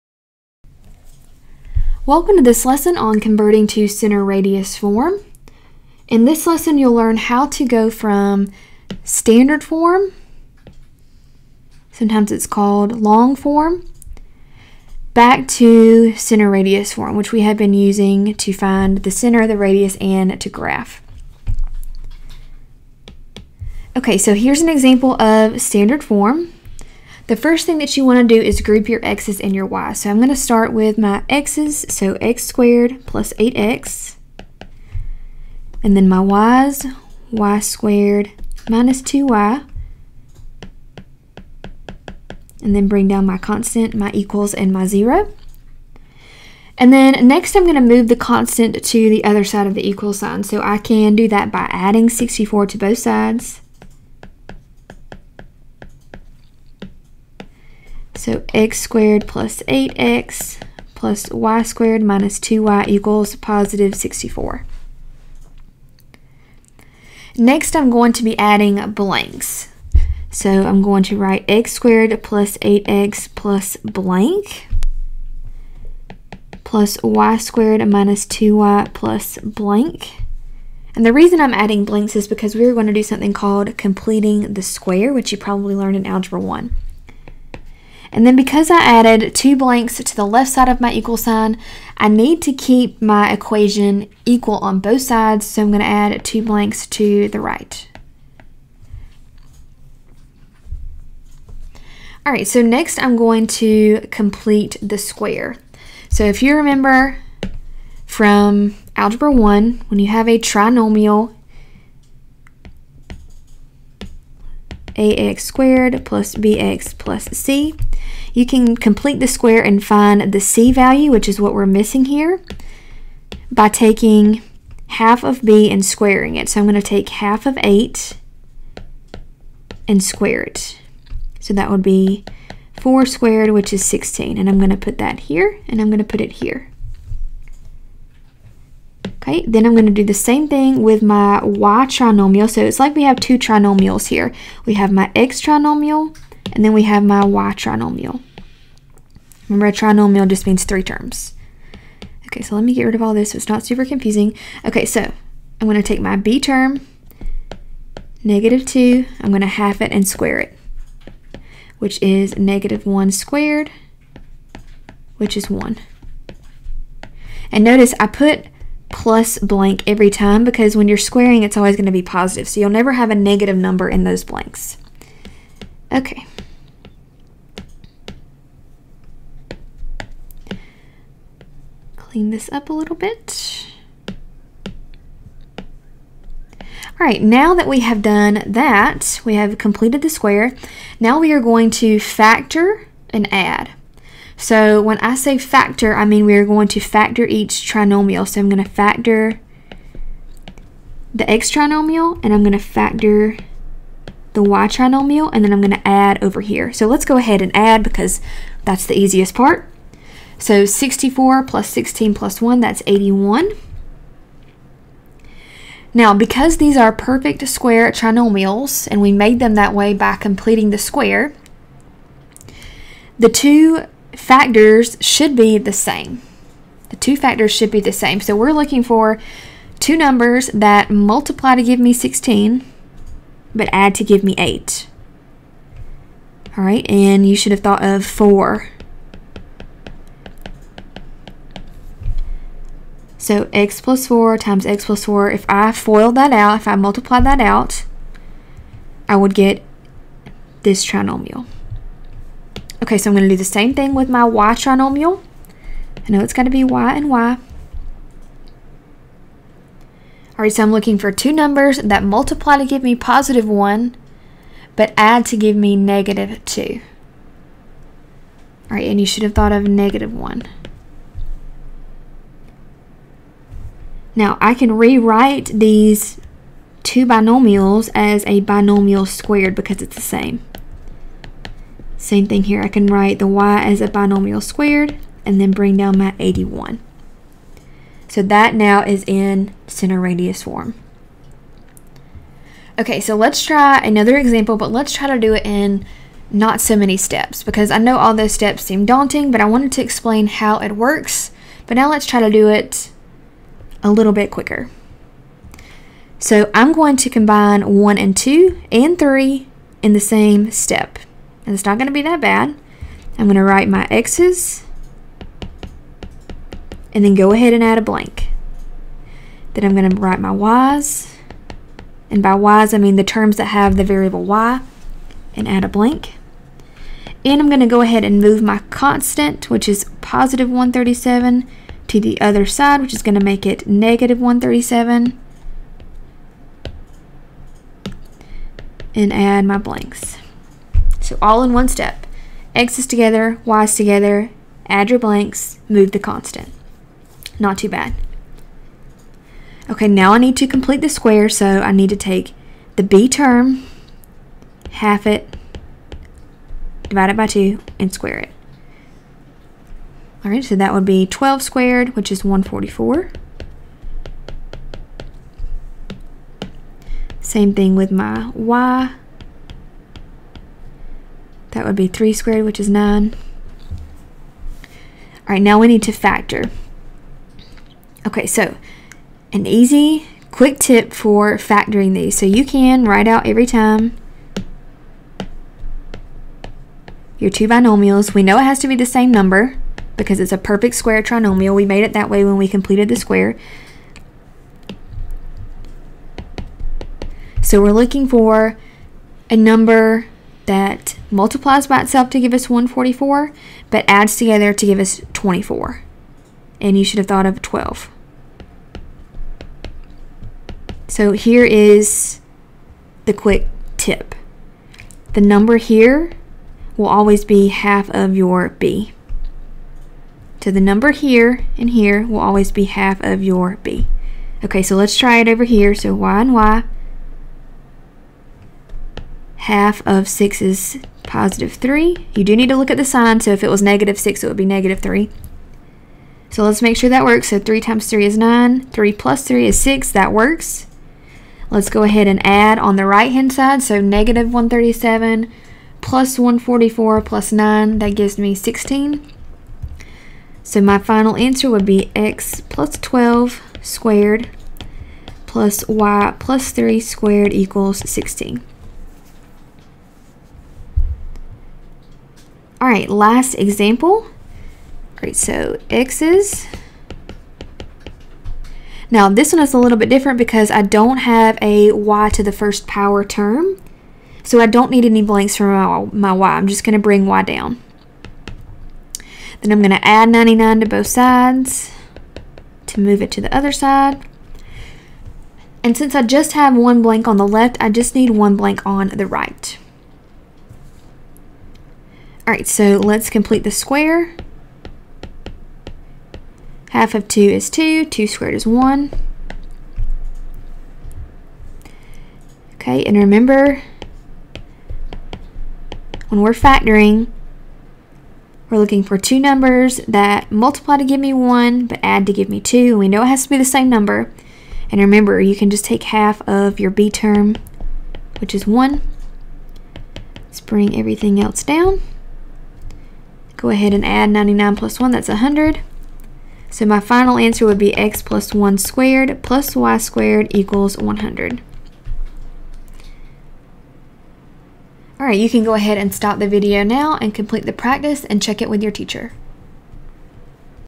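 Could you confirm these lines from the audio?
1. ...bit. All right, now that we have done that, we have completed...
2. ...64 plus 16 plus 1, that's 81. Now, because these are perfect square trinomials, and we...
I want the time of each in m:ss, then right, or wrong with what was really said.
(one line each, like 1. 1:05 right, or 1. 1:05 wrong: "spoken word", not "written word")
1. 3:02 right
2. 3:30 right.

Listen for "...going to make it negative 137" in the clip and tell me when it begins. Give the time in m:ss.
5:33.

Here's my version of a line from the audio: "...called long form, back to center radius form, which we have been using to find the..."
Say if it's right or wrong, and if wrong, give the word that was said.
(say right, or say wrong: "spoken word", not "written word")
right.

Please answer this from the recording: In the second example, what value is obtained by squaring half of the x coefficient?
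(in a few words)
144.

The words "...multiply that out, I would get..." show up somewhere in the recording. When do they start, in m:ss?
4:06.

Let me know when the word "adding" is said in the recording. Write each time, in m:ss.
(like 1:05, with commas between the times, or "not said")
0:51, 1:08, 1:21.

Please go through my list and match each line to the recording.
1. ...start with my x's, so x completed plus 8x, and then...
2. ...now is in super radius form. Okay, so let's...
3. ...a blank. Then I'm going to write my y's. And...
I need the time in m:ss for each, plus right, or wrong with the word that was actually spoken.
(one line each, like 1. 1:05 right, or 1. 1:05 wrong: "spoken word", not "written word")
1. 0:30 wrong: "squared", not "completed"
2. 4:48 wrong: "center", not "super"
3. 5:17 right.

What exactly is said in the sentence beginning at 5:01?
But now let's try to do it a little bit quicker.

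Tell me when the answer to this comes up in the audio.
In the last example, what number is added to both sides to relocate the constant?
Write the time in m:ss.
7:59.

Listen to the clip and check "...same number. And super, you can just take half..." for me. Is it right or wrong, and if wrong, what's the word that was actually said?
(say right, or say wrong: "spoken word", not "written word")
wrong: "remember", not "super".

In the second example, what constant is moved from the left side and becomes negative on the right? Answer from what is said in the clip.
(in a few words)
137.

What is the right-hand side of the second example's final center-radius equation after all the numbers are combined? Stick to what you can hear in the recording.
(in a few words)
16.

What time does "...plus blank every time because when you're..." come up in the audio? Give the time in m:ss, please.
2:48.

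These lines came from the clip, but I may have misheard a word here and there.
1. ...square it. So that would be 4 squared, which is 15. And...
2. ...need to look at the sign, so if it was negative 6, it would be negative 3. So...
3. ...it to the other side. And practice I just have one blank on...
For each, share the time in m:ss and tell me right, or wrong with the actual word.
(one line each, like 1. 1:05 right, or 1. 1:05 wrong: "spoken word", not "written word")
1. 2:10 wrong: "16", not "15"
2. 7:12 right
3. 8:03 wrong: "since", not "practice".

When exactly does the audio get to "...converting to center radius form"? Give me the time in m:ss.
0:03.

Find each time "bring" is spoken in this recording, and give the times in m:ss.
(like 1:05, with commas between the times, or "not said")
0:42, 4:45, 7:56, 8:40.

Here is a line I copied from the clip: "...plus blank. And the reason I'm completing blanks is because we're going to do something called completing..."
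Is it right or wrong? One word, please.
wrong.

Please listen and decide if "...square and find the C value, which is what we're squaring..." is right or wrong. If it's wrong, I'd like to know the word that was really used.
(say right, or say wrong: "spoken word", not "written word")
wrong: "missing", not "squaring".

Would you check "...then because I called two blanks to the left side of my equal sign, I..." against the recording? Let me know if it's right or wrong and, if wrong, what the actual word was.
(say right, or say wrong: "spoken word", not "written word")
wrong: "added", not "called".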